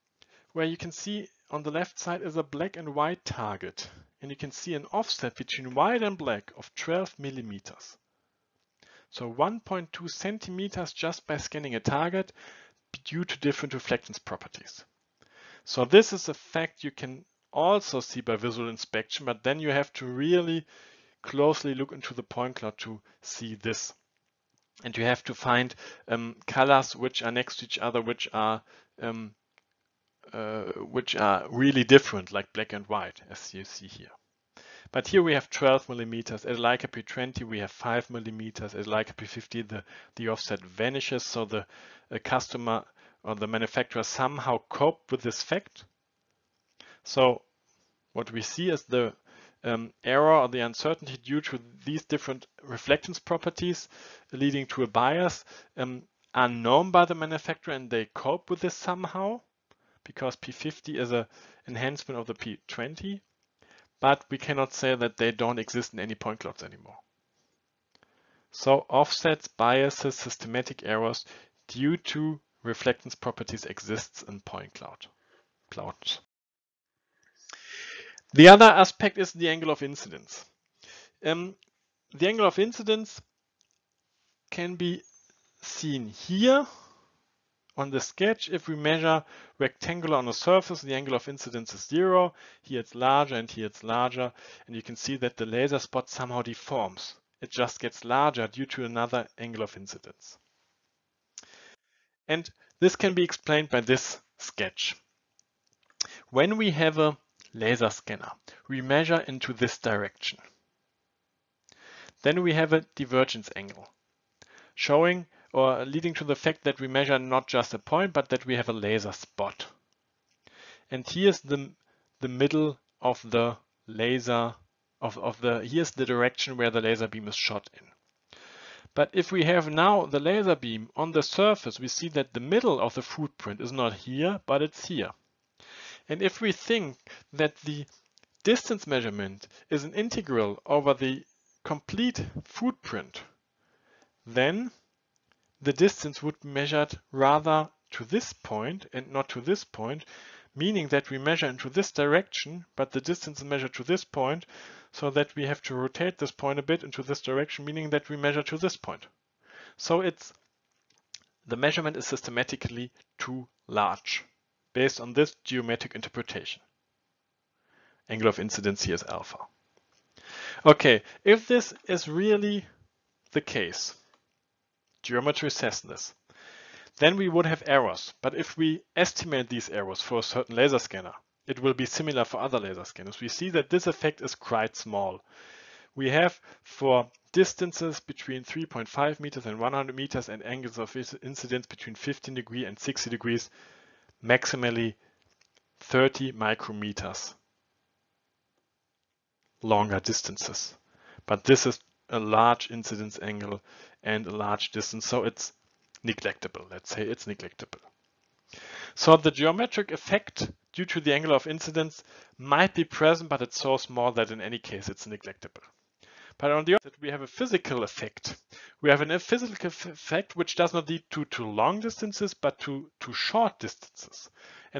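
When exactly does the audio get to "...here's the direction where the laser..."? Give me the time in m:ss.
2:05.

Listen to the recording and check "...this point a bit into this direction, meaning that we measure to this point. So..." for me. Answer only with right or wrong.
right.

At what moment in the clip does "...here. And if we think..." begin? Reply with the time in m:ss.
2:14.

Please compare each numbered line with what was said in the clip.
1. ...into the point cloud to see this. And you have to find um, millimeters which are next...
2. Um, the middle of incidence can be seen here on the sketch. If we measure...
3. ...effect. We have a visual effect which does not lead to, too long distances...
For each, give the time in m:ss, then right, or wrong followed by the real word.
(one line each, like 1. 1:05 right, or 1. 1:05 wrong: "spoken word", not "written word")
1. 0:21 wrong: "colors", not "millimeters"
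2. 1:21 wrong: "angle", not "middle"
3. 3:37 wrong: "physical", not "visual".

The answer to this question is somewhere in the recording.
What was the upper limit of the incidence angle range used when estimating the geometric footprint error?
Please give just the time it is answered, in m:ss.
3:12.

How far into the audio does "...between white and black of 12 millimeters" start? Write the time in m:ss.
0:05.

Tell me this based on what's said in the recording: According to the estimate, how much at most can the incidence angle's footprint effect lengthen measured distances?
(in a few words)
30 micrometers.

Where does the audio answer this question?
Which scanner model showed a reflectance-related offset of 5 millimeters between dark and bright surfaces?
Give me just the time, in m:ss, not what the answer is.
0:36.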